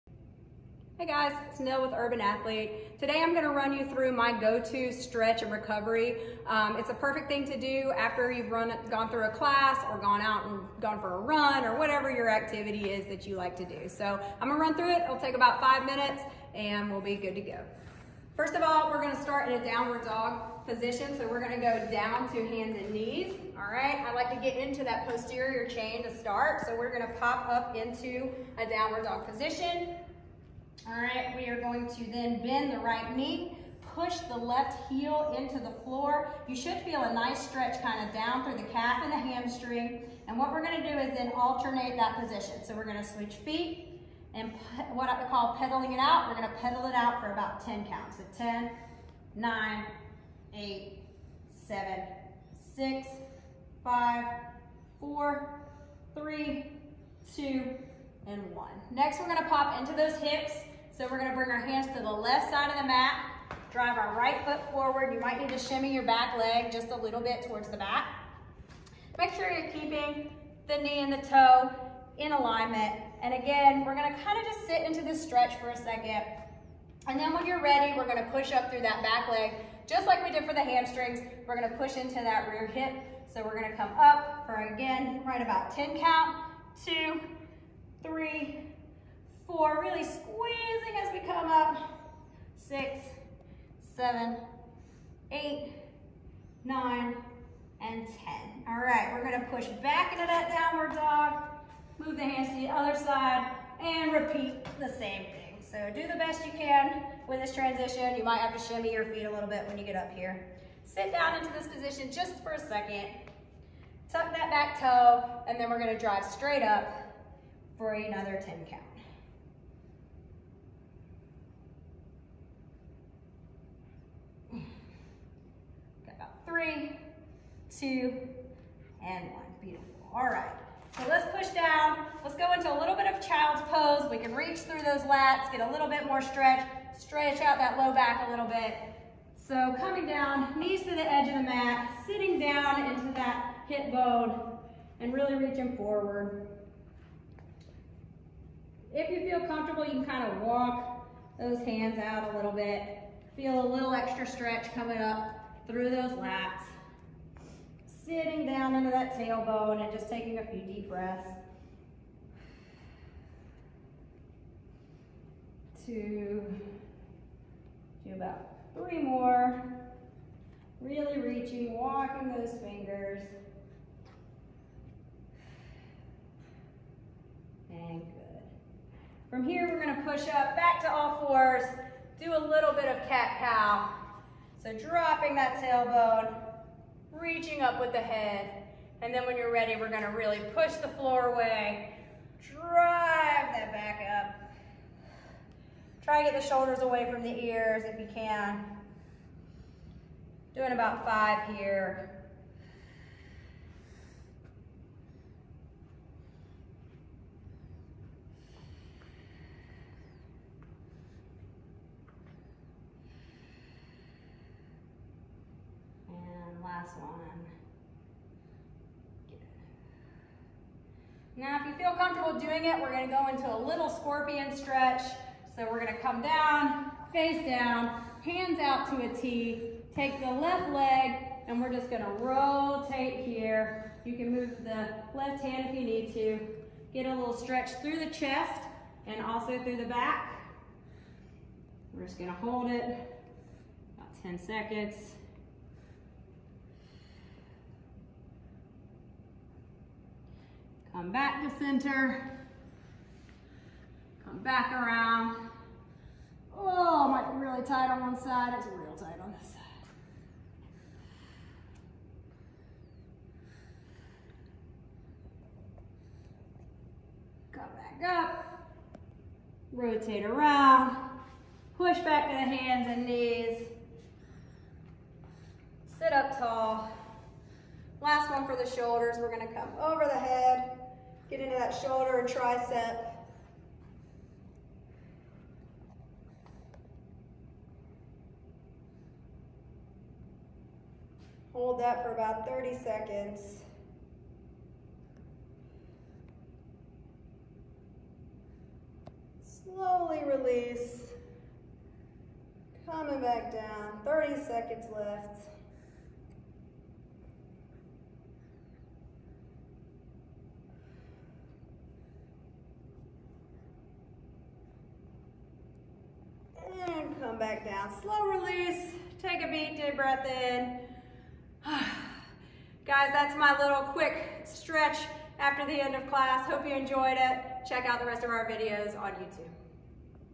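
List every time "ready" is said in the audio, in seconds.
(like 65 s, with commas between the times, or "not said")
77 s, 189 s.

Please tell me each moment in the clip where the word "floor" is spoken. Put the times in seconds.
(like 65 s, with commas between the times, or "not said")
35 s, 190 s.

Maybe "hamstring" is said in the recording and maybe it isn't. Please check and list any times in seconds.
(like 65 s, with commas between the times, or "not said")
39 s, 80 s.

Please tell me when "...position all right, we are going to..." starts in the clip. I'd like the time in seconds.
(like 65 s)
29 s.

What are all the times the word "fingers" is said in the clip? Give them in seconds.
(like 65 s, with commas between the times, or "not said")
172 s.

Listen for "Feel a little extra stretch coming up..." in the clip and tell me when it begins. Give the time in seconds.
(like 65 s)
153 s.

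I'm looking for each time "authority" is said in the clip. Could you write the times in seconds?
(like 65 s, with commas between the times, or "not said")
not said.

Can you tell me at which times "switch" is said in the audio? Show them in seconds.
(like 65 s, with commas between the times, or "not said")
43 s.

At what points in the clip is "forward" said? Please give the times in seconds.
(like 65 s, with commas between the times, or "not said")
64 s, 145 s.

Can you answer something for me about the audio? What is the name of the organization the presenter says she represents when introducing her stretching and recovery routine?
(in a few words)
Urban Athlete.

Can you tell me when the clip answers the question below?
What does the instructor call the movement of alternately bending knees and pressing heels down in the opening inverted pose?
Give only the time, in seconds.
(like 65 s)
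45 s.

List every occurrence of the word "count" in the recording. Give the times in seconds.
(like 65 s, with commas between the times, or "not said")
47 s, 85 s, 118 s.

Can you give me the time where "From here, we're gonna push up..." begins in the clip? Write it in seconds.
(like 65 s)
179 s.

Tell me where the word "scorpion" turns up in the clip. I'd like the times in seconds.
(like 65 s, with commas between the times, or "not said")
223 s.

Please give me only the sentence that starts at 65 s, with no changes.
You might need to shimmy your back leg just a little bit towards the back.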